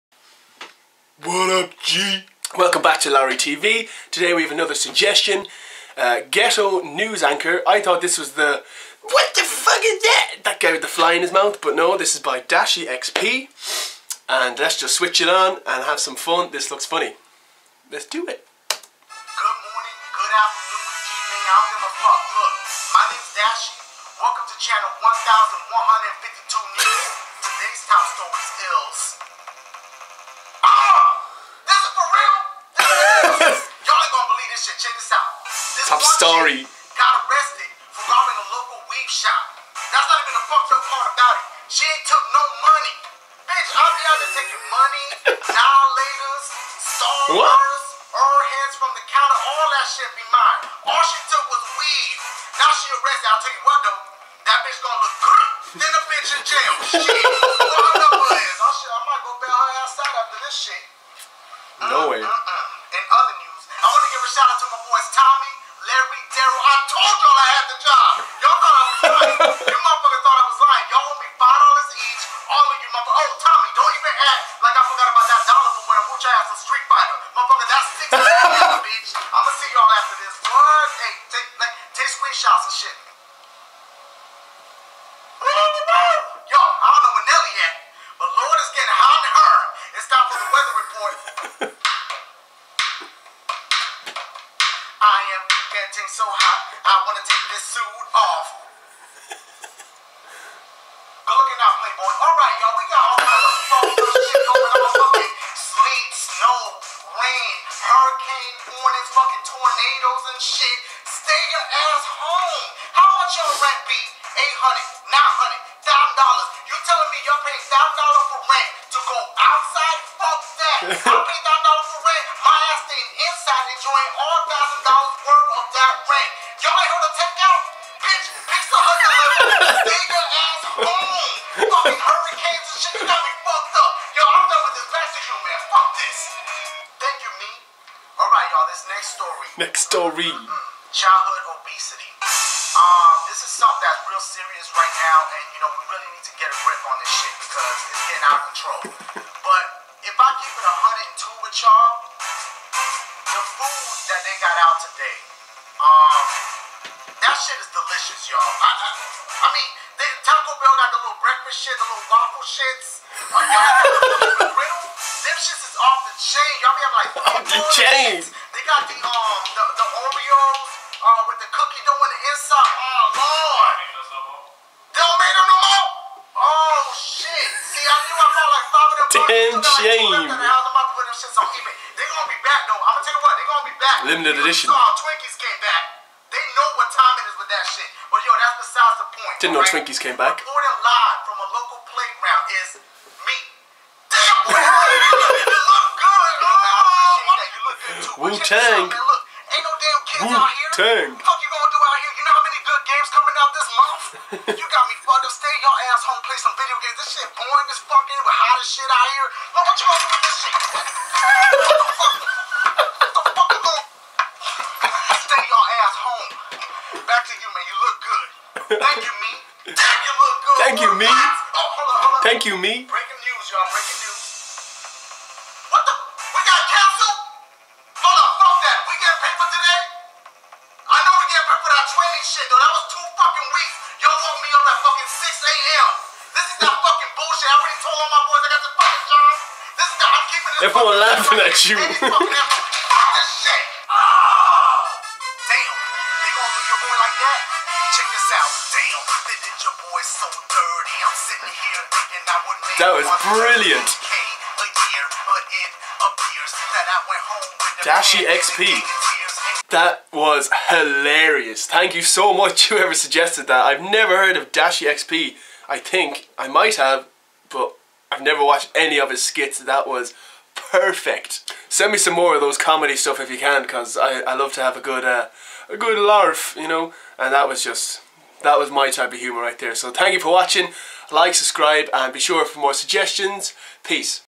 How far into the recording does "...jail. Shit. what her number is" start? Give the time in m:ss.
0:56.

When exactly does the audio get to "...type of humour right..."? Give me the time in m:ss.
4:38.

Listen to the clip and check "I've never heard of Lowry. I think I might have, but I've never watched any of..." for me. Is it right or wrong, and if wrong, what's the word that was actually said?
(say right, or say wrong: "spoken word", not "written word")
wrong: "DashieXP", not "Lowry".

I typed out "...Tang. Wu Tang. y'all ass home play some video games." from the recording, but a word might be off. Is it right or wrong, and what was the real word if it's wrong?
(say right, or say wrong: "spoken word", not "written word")
right.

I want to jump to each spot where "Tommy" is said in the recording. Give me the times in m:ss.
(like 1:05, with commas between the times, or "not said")
1:13.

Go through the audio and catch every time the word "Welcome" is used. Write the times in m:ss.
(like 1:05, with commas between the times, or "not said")
0:02, 0:24.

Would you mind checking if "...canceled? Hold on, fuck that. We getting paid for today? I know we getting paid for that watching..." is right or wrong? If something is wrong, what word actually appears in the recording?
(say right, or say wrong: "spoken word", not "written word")
wrong: "training", not "watching".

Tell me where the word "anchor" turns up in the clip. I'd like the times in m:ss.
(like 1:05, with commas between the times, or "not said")
0:07.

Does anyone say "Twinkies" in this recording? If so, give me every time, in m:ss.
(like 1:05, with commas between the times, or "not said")
3:04, 3:09.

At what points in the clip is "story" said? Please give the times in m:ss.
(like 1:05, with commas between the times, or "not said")
0:36, 2:19.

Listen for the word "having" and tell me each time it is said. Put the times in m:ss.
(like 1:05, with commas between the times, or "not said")
2:46.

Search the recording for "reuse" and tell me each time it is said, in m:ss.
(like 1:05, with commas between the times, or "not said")
not said.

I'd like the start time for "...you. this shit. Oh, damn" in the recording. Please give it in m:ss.
4:01.